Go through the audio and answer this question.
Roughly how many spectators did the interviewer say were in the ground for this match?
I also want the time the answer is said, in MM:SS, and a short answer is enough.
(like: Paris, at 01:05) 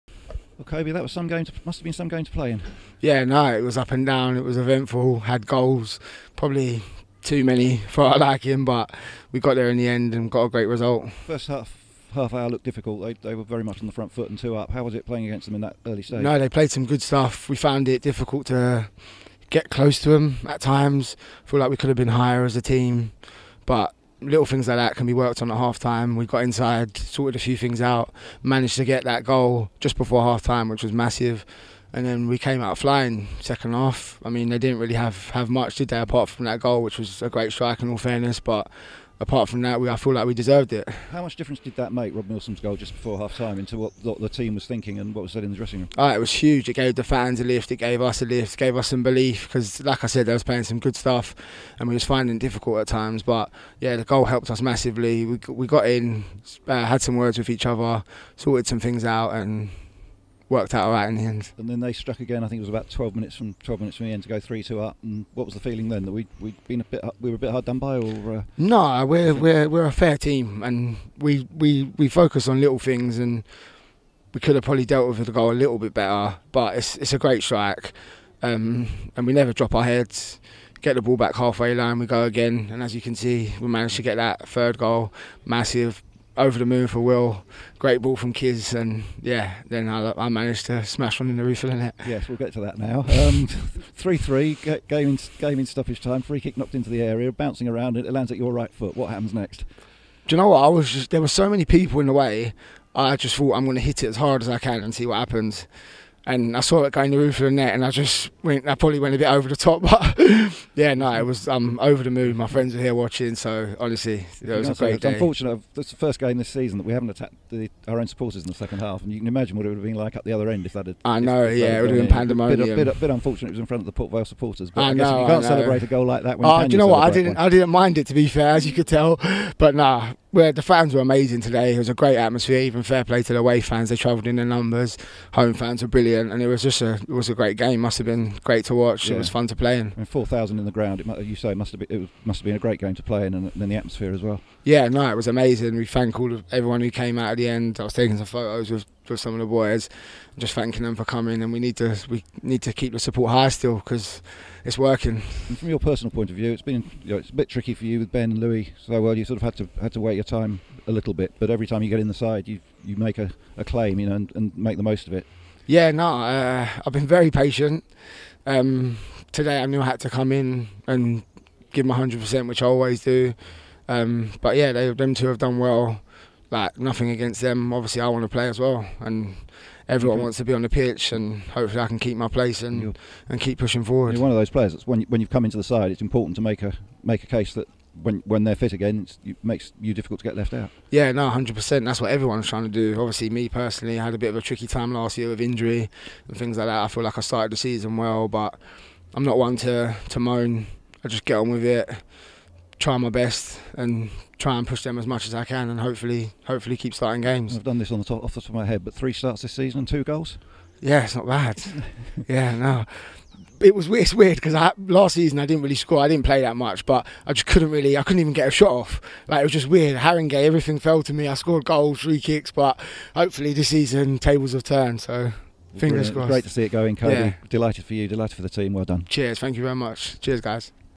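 4000, at 02:20.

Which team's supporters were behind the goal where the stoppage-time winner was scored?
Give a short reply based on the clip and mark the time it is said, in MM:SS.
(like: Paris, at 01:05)
Port Vale, at 02:03.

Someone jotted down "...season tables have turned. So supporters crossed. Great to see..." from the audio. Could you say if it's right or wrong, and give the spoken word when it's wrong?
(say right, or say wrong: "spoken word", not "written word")
wrong: "fingers", not "supporters".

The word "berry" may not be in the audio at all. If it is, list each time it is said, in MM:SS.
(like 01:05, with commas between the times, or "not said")
not said.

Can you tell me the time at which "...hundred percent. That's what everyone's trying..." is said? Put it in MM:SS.
03:11.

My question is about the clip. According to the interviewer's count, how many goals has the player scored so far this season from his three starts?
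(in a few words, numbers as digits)
2.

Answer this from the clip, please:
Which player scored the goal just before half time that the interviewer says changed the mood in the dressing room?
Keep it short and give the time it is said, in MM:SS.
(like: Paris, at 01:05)
Rob Milsom, at 00:42.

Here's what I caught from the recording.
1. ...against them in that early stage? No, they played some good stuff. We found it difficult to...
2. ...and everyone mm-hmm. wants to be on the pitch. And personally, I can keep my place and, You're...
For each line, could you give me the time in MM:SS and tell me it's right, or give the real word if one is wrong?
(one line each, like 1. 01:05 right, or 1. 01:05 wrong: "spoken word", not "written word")
1. 00:15 right
2. 02:58 wrong: "hopefully", not "personally".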